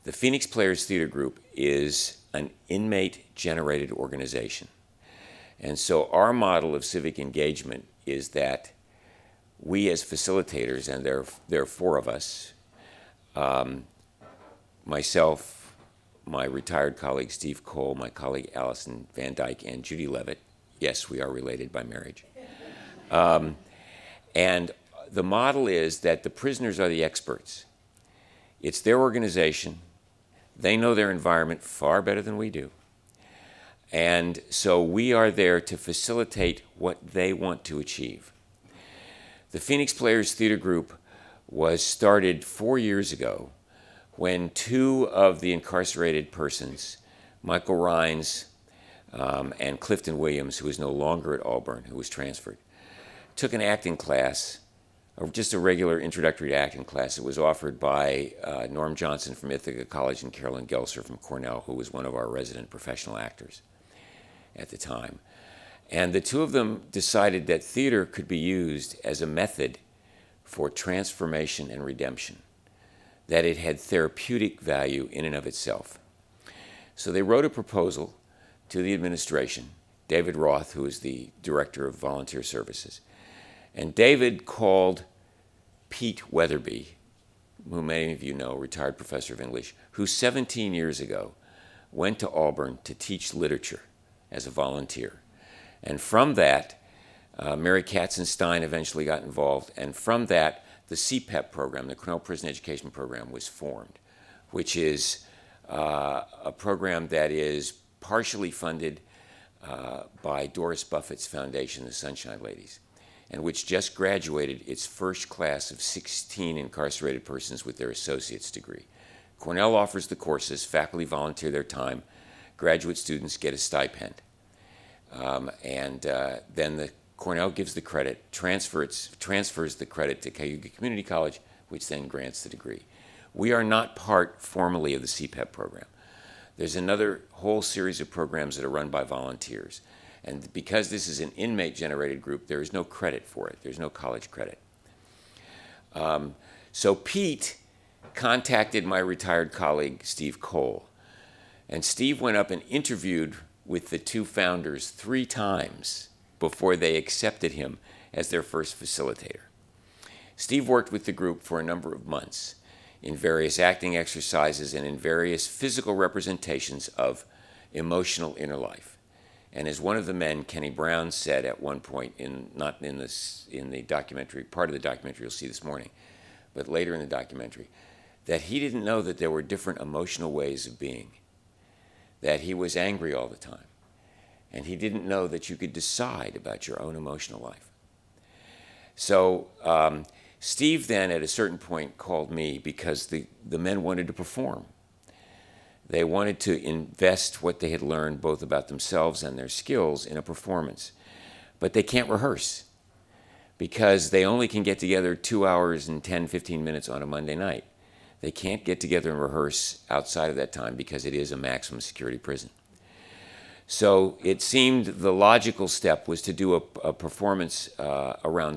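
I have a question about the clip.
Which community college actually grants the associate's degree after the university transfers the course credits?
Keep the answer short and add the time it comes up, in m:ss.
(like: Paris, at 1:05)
Cayuga Community College, at 2:10.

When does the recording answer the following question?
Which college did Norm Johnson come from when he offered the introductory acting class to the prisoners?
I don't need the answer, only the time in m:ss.
0:59.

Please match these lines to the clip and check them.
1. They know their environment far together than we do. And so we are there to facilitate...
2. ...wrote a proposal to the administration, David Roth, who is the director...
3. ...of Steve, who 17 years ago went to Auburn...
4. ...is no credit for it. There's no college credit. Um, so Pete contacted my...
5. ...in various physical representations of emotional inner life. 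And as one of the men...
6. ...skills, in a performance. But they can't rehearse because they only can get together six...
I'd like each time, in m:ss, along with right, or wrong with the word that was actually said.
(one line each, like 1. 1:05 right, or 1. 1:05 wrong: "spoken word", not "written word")
1. 0:30 wrong: "better", not "together"
2. 1:17 right
3. 1:29 wrong: "English", not "Steve"
4. 2:22 right
5. 2:44 right
6. 3:19 wrong: "two", not "six".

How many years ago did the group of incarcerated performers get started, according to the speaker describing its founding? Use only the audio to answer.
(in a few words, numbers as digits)
4.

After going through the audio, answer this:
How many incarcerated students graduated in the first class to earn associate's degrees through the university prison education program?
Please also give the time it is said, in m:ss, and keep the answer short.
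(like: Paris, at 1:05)
16, at 1:55.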